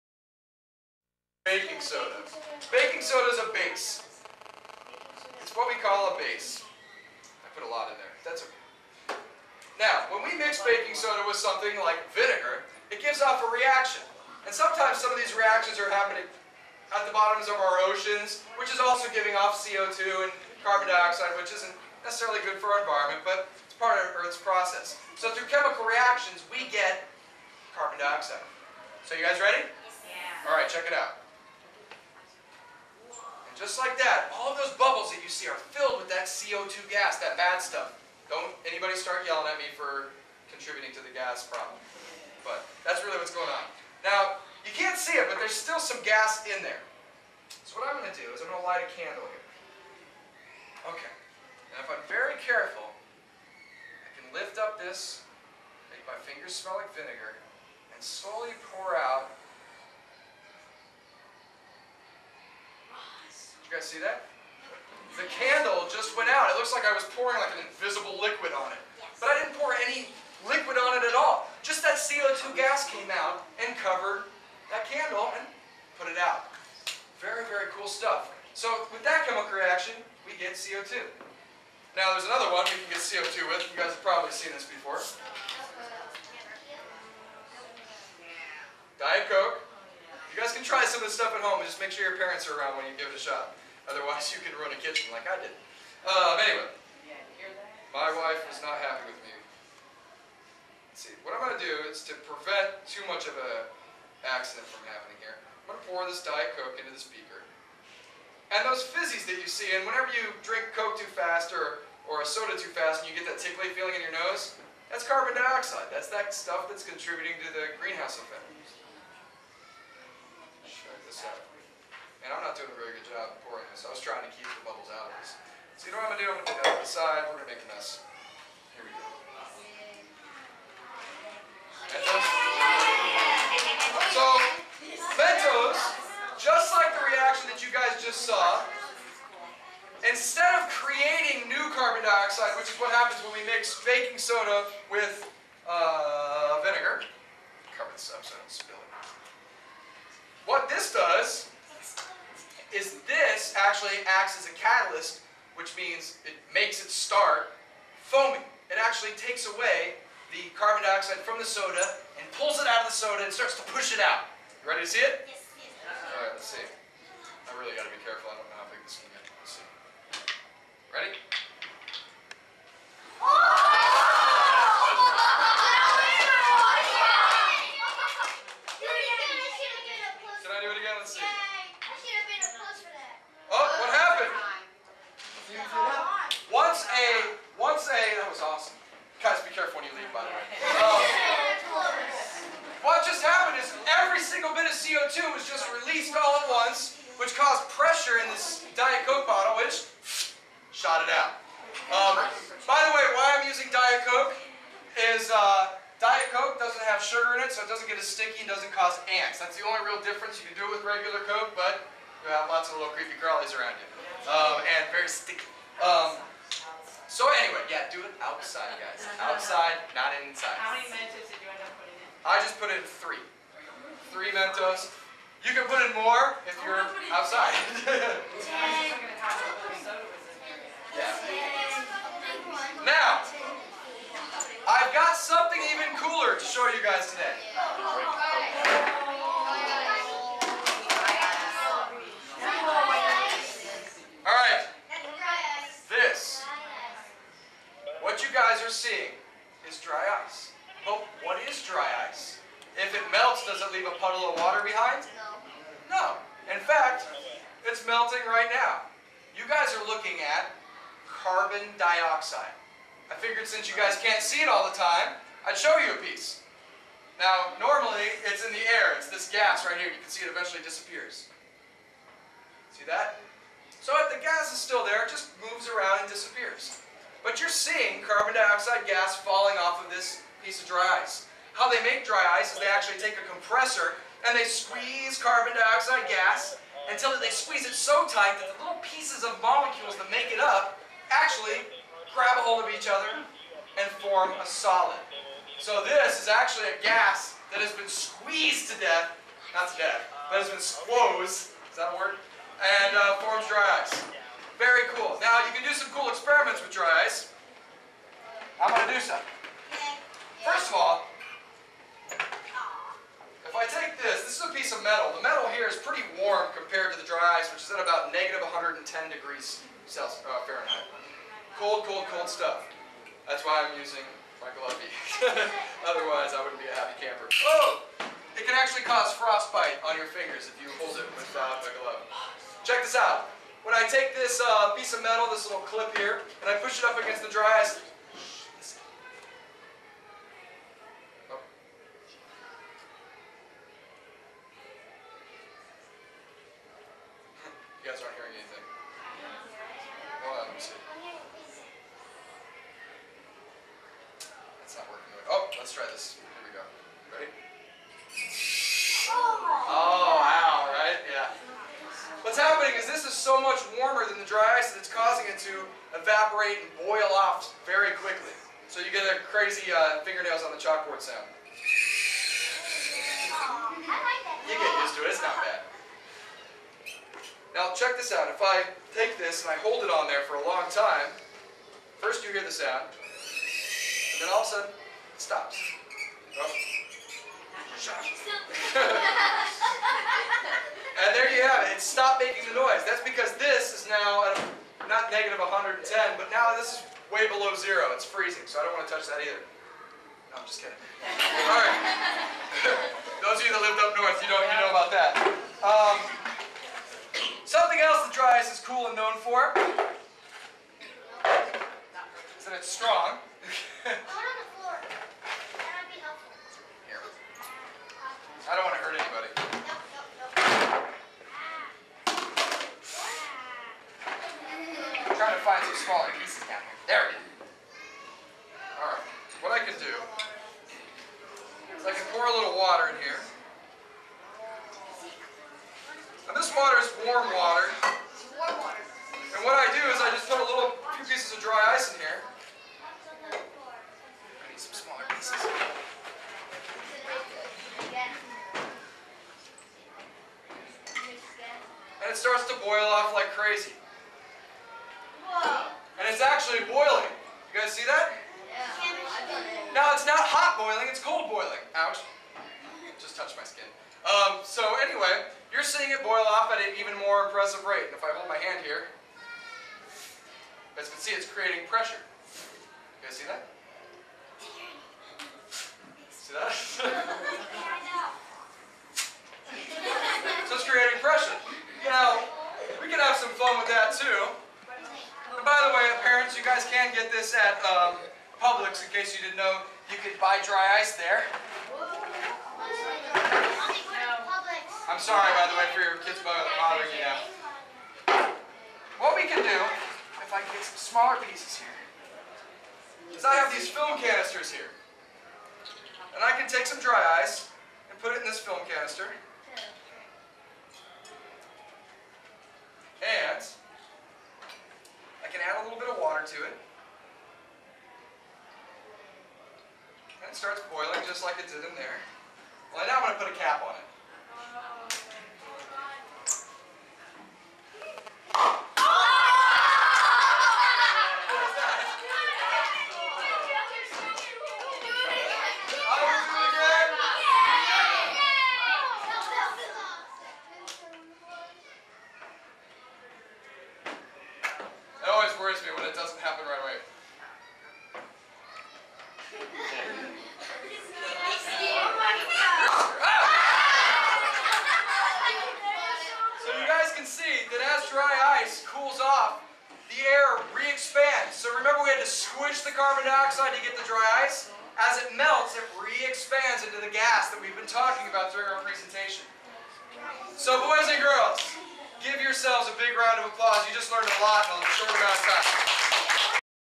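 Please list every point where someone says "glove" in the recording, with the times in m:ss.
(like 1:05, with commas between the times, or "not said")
5:24, 5:31.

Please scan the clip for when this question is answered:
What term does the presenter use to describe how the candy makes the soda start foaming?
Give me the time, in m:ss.
2:34.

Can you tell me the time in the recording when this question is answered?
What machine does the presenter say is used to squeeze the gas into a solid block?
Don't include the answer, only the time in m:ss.
4:43.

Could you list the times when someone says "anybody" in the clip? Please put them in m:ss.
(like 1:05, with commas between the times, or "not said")
0:38, 6:58.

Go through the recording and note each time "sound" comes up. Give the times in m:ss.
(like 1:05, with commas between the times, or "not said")
6:11, 6:22.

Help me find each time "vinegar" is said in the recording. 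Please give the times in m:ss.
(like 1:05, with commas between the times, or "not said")
0:12, 0:56, 2:26.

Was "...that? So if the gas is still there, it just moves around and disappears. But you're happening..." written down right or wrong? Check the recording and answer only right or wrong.
wrong.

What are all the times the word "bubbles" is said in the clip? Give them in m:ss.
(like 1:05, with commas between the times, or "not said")
0:34, 2:04.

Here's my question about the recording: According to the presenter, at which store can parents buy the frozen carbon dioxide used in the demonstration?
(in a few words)
Publix.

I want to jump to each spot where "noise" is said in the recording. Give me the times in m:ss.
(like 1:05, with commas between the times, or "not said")
6:32.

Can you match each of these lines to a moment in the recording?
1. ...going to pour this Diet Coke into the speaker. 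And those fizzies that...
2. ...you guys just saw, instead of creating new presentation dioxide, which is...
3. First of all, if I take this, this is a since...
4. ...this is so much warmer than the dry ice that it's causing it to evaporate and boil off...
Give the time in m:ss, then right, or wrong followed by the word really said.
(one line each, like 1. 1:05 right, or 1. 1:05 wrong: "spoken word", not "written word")
1. 1:45 right
2. 2:17 wrong: "carbon", not "presentation"
3. 5:10 wrong: "piece", not "since"
4. 6:02 right.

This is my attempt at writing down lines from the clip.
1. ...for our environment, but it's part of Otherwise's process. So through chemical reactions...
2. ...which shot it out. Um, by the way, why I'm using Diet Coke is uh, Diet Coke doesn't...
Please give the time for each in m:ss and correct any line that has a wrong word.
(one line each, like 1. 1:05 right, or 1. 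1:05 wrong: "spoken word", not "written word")
1. 0:22 wrong: "Earth", not "Otherwise"
2. 3:19 right.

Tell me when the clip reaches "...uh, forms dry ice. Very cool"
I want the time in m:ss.
5:02.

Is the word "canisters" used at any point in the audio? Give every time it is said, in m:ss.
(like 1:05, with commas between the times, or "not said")
8:24, 8:28.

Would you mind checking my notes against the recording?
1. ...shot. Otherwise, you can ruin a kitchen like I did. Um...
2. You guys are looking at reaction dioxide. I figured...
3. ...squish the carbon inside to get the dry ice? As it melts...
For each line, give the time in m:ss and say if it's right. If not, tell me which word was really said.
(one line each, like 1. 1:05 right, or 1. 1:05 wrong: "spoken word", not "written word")
1. 1:33 right
2. 4:19 wrong: "carbon", not "reaction"
3. 9:22 wrong: "dioxide", not "inside".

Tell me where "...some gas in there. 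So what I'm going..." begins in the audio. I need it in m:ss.
0:45.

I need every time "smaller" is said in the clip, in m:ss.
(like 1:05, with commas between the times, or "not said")
7:05, 7:24, 8:20.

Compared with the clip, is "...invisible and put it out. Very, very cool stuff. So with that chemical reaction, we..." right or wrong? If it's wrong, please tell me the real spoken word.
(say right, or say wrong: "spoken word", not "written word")
wrong: "candle", not "invisible".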